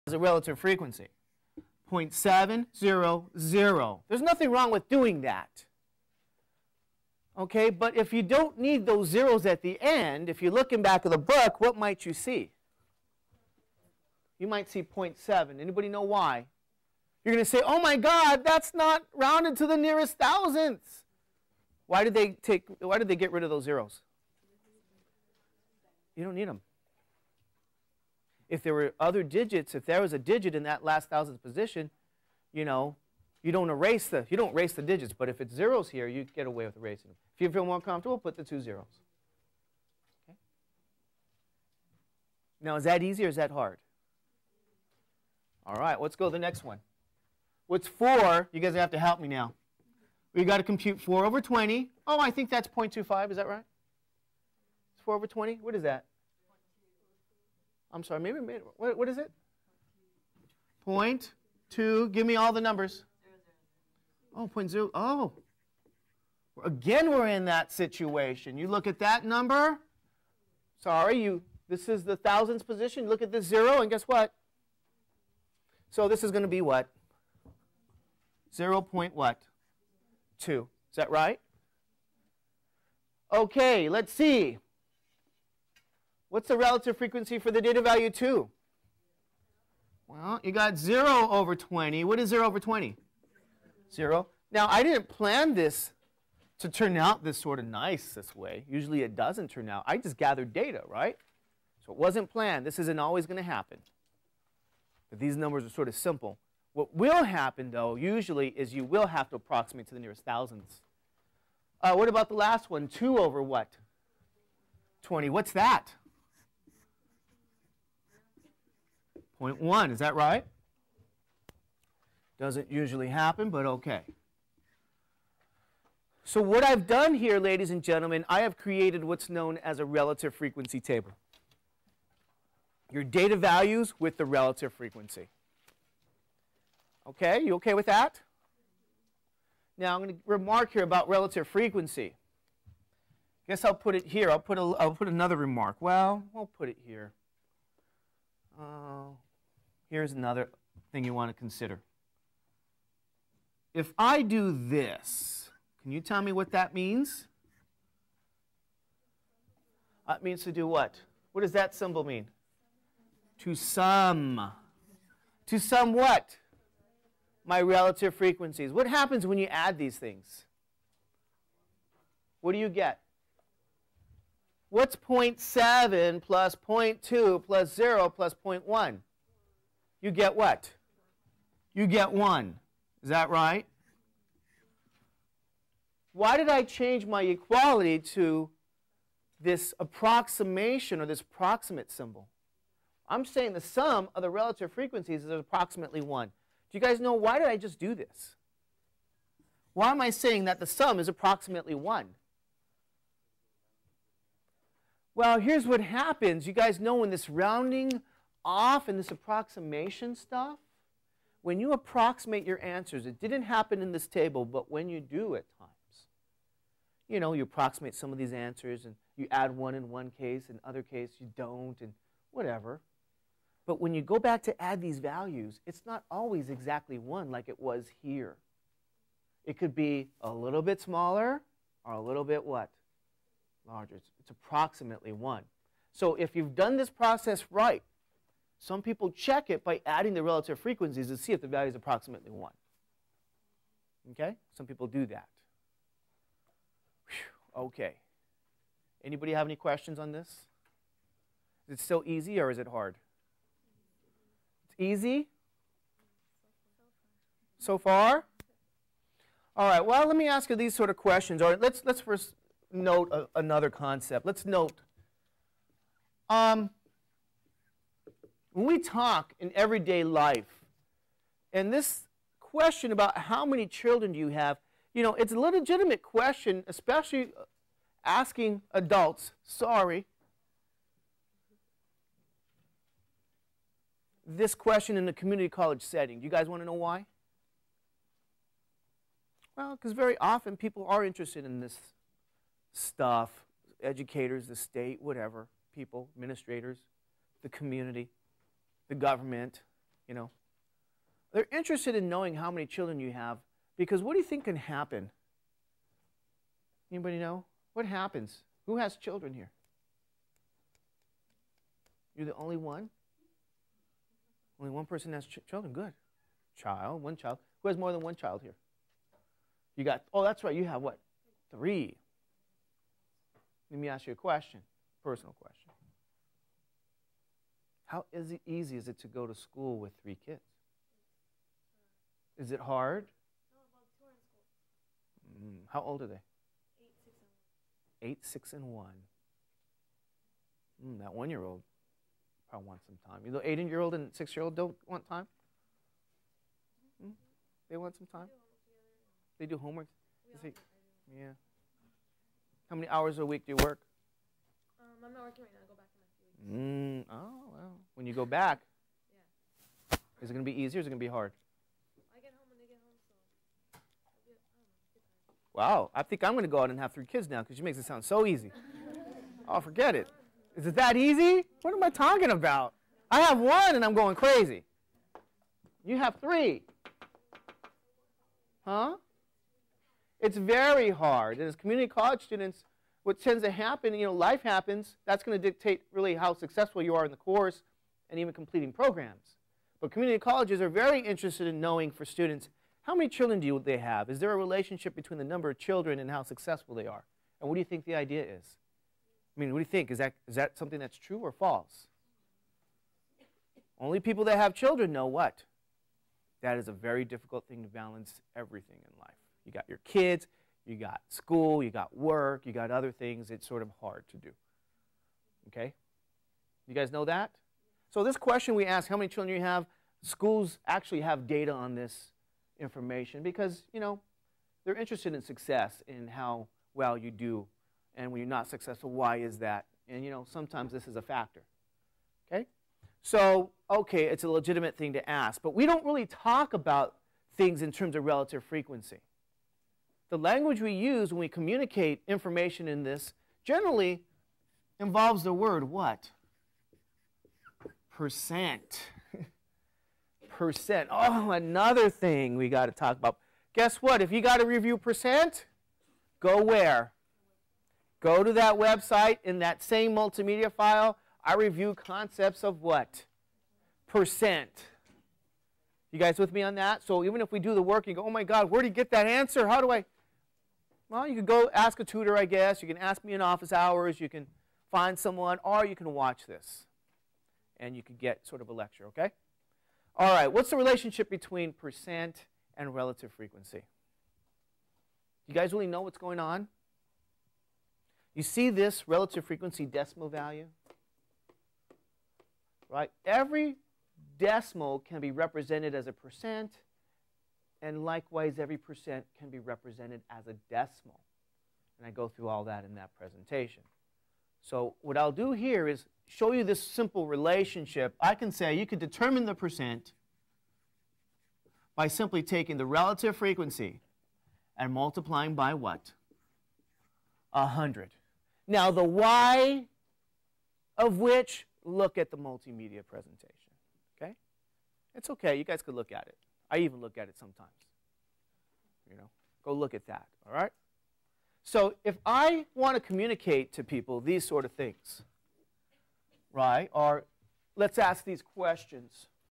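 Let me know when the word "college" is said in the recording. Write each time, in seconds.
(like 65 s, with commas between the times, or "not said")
285 s, 381 s, 390 s.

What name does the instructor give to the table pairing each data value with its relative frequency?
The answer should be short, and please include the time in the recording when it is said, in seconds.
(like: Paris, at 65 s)
relative frequency table, at 129 s.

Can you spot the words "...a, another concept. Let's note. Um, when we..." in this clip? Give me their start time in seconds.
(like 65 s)
263 s.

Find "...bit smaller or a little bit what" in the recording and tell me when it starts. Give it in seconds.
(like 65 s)
230 s.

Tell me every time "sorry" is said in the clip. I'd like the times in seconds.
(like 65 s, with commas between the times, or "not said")
58 s, 70 s, 279 s.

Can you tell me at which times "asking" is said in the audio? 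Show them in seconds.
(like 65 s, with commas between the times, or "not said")
278 s.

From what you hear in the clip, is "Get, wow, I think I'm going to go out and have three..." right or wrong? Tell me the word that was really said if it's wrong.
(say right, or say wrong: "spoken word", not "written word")
right.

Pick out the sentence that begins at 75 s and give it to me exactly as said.
So this is going to be what?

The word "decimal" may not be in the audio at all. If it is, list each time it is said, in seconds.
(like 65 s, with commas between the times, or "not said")
489 s, 494 s, 500 s.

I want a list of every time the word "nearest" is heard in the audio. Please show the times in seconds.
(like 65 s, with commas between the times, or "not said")
19 s, 109 s.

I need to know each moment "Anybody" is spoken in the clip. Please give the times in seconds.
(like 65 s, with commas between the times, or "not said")
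15 s, 249 s, 306 s.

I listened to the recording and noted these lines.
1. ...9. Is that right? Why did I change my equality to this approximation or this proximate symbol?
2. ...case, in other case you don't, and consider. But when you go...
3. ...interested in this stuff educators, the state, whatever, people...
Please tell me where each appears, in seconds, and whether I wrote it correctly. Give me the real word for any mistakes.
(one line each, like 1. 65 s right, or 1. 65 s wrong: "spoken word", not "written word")
1. 182 s wrong: "1", not "9"
2. 220 s wrong: "whatever", not "consider"
3. 291 s right.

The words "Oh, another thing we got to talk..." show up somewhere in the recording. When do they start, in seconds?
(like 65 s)
450 s.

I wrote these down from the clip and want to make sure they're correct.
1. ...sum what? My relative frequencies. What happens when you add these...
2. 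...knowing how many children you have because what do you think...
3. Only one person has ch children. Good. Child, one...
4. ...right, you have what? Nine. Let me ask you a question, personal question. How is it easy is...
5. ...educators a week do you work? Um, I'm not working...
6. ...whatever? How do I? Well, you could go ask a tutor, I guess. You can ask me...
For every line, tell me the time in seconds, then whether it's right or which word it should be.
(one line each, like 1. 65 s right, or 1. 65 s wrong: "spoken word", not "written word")
1. 165 s right
2. 302 s right
3. 314 s right
4. 320 s wrong: "Three", not "Nine"
5. 352 s wrong: "hours", not "educators"
6. 469 s wrong: "answer", not "whatever".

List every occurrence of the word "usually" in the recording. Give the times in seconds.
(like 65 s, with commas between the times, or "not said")
98 s, 107 s, 122 s.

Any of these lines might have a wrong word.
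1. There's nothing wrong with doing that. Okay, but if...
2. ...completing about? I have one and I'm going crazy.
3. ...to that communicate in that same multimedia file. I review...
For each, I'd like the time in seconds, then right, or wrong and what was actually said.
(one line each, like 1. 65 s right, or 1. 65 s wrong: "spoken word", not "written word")
1. 4 s right
2. 371 s wrong: "talking", not "completing"
3. 458 s wrong: "website", not "communicate".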